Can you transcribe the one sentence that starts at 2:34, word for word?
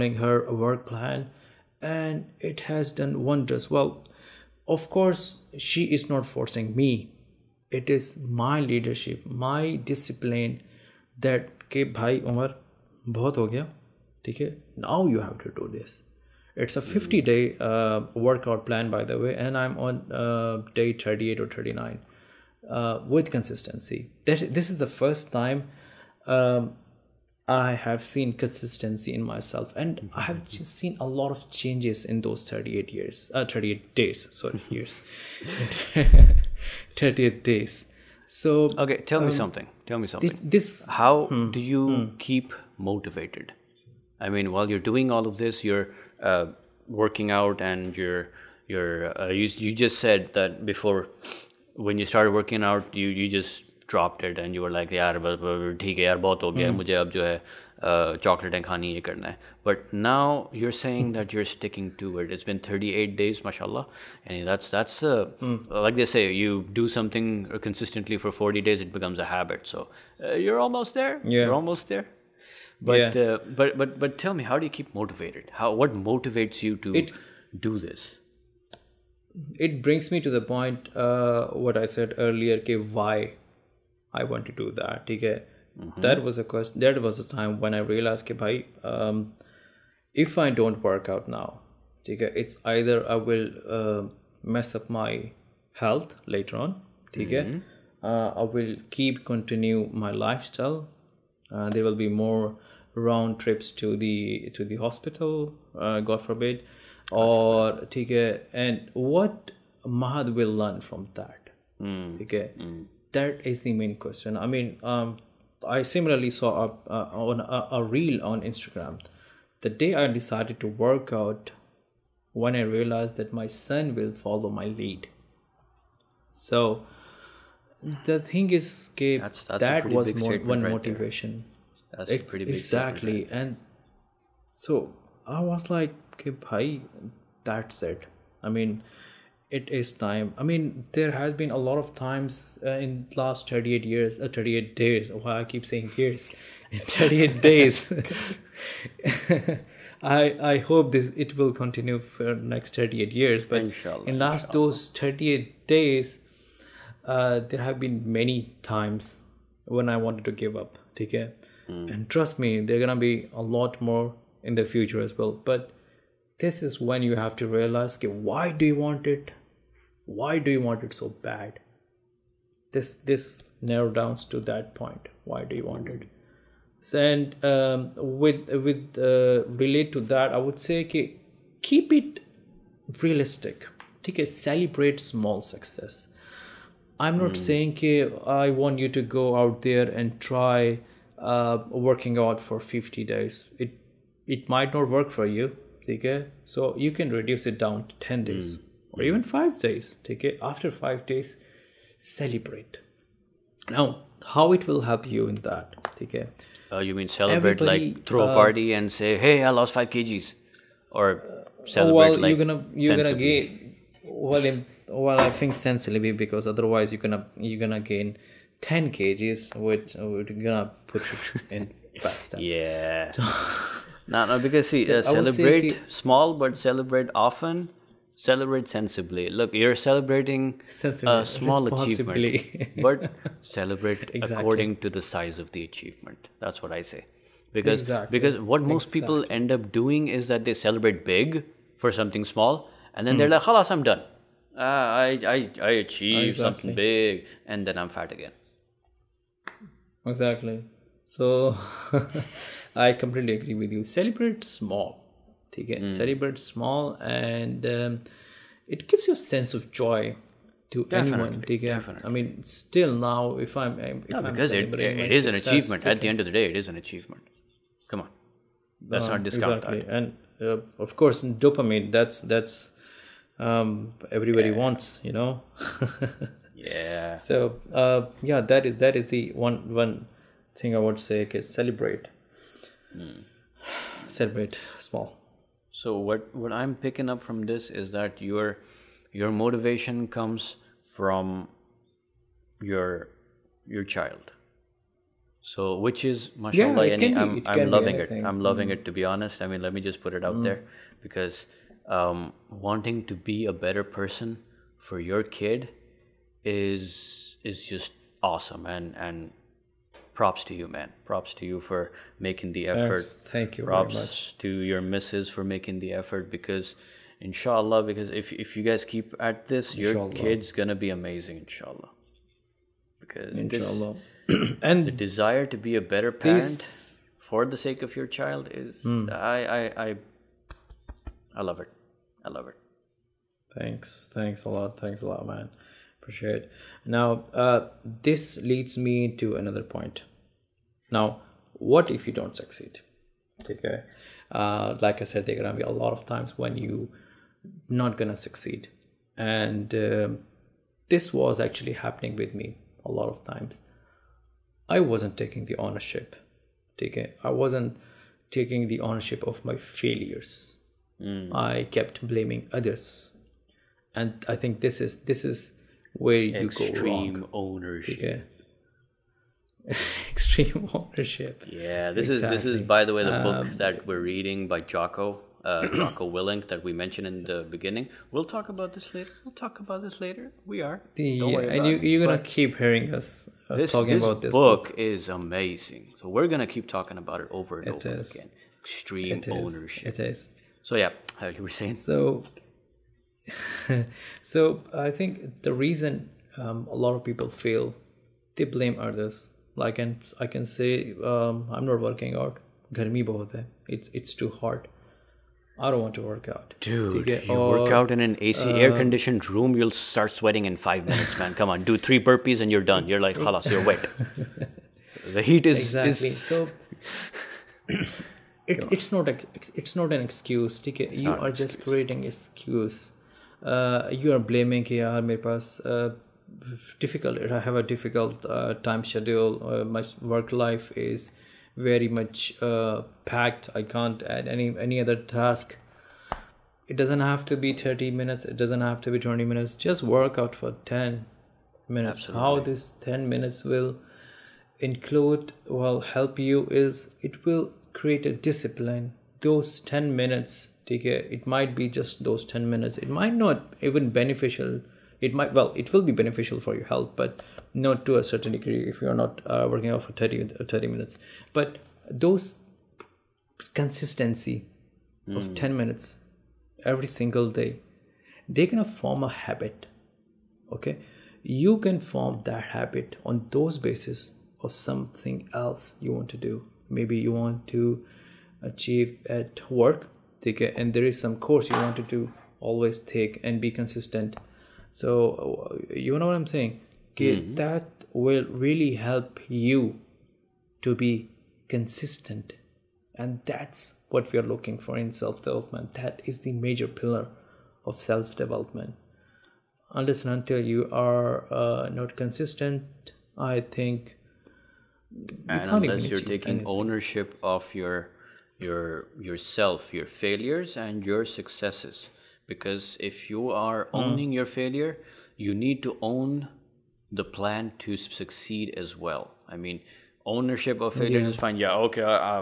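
those 38 days uh, there have been many times when i wanted to give up take care mm.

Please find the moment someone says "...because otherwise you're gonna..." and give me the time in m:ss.
3:36.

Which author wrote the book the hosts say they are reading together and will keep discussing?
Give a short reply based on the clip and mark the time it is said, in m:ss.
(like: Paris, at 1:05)
Jocko Willink, at 6:15.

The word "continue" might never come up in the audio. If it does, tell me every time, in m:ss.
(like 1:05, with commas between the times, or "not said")
1:39, 2:31.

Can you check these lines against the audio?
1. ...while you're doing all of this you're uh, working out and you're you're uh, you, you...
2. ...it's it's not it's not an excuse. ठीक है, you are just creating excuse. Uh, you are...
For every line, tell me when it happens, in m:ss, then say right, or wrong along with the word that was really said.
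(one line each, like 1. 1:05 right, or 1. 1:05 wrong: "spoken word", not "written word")
1. 0:44 right
2. 6:58 right.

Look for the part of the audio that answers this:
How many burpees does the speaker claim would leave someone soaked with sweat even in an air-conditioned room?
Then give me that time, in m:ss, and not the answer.
6:51.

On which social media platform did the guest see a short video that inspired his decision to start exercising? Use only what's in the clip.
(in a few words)
Instagram.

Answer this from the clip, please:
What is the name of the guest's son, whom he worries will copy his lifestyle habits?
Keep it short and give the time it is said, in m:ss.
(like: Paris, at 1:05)
Mahad, at 1:49.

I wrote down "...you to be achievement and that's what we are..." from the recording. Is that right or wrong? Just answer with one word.
wrong.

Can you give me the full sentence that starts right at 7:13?
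I can't add any any other task.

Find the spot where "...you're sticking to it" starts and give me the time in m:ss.
1:01.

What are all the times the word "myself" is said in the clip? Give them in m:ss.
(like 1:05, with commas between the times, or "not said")
0:29.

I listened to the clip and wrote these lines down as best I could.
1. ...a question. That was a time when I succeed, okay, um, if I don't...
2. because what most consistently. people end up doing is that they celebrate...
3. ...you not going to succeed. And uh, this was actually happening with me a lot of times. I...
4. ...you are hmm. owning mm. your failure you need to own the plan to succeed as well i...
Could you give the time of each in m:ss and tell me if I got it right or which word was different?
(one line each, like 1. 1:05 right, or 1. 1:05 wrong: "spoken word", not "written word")
1. 1:26 wrong: "realized", not "succeed"
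2. 3:58 wrong: "exactly", not "consistently"
3. 5:46 right
4. 8:33 right.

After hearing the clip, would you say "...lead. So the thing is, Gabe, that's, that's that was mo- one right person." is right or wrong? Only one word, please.
wrong.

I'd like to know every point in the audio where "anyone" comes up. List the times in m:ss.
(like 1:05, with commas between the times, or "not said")
4:21.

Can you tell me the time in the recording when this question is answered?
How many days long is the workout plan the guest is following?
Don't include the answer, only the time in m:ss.
0:16.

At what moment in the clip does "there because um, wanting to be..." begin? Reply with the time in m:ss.
5:00.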